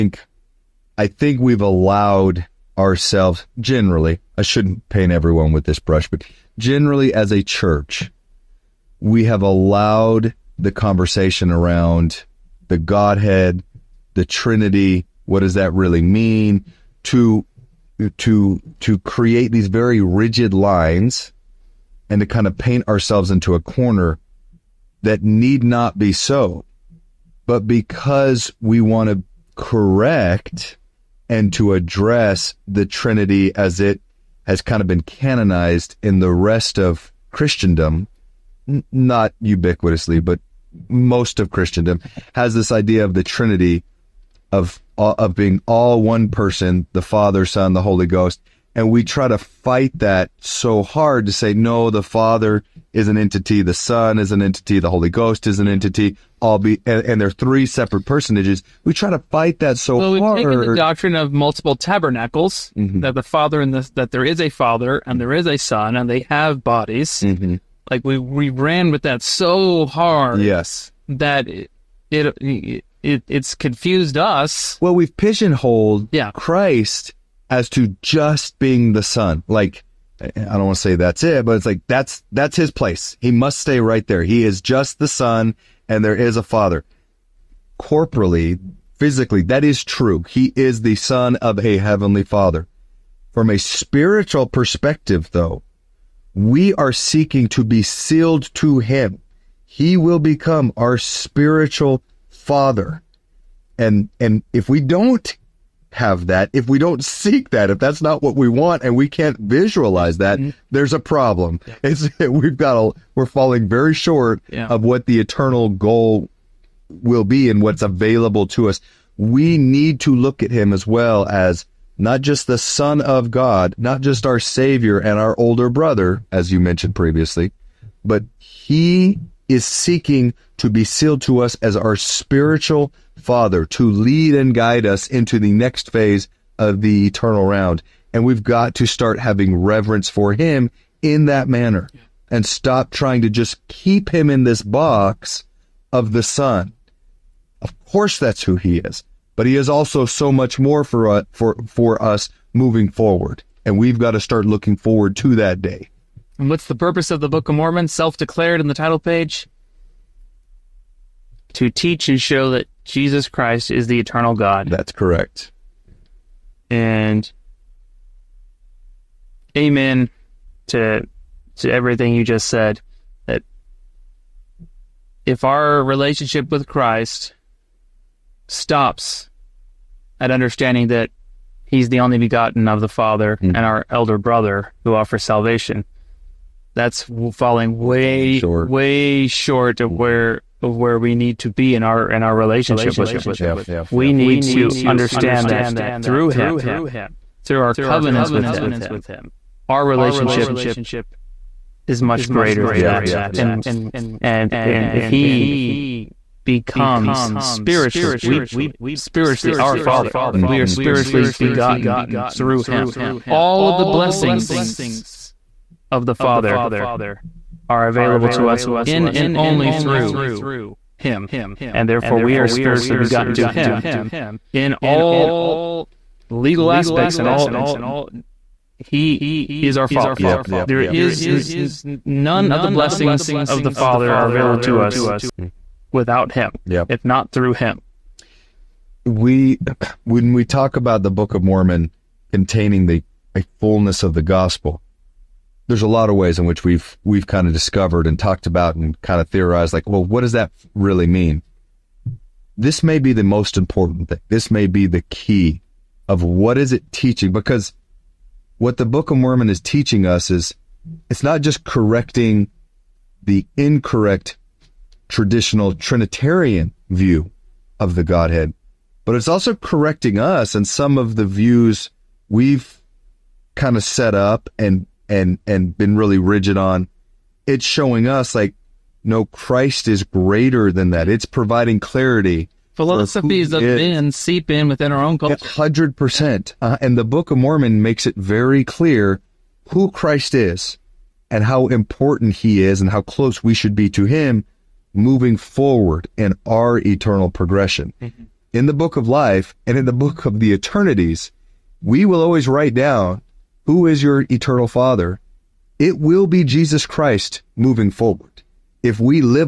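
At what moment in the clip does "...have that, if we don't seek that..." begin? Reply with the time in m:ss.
1:45.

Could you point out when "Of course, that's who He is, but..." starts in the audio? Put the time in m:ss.
2:27.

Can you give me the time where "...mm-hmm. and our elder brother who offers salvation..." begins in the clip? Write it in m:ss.
3:03.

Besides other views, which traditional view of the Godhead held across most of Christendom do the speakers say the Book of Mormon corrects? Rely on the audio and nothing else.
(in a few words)
Trinitarian.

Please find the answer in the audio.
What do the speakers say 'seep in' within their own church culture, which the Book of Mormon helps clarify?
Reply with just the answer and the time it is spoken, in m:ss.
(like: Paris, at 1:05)
philosophies of men, at 4:42.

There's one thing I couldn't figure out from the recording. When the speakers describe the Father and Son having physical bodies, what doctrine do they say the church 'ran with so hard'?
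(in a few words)
multiple tabernacles.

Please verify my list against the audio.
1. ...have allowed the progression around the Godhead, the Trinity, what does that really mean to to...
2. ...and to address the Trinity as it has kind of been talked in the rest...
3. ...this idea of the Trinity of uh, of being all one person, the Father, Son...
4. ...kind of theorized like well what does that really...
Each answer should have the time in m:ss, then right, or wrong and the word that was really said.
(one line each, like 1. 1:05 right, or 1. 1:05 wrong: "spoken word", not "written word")
1. 0:09 wrong: "conversation", not "progression"
2. 0:31 wrong: "canonized", not "talked"
3. 0:42 right
4. 4:09 right.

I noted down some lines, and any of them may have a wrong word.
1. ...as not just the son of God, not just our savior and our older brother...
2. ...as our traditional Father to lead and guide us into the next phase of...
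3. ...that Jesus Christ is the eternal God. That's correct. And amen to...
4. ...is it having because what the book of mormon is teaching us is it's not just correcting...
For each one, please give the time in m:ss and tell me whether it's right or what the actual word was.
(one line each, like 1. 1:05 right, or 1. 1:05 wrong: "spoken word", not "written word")
1. 2:01 right
2. 2:11 wrong: "spiritual", not "traditional"
3. 2:42 right
4. 4:16 wrong: "teaching", not "having".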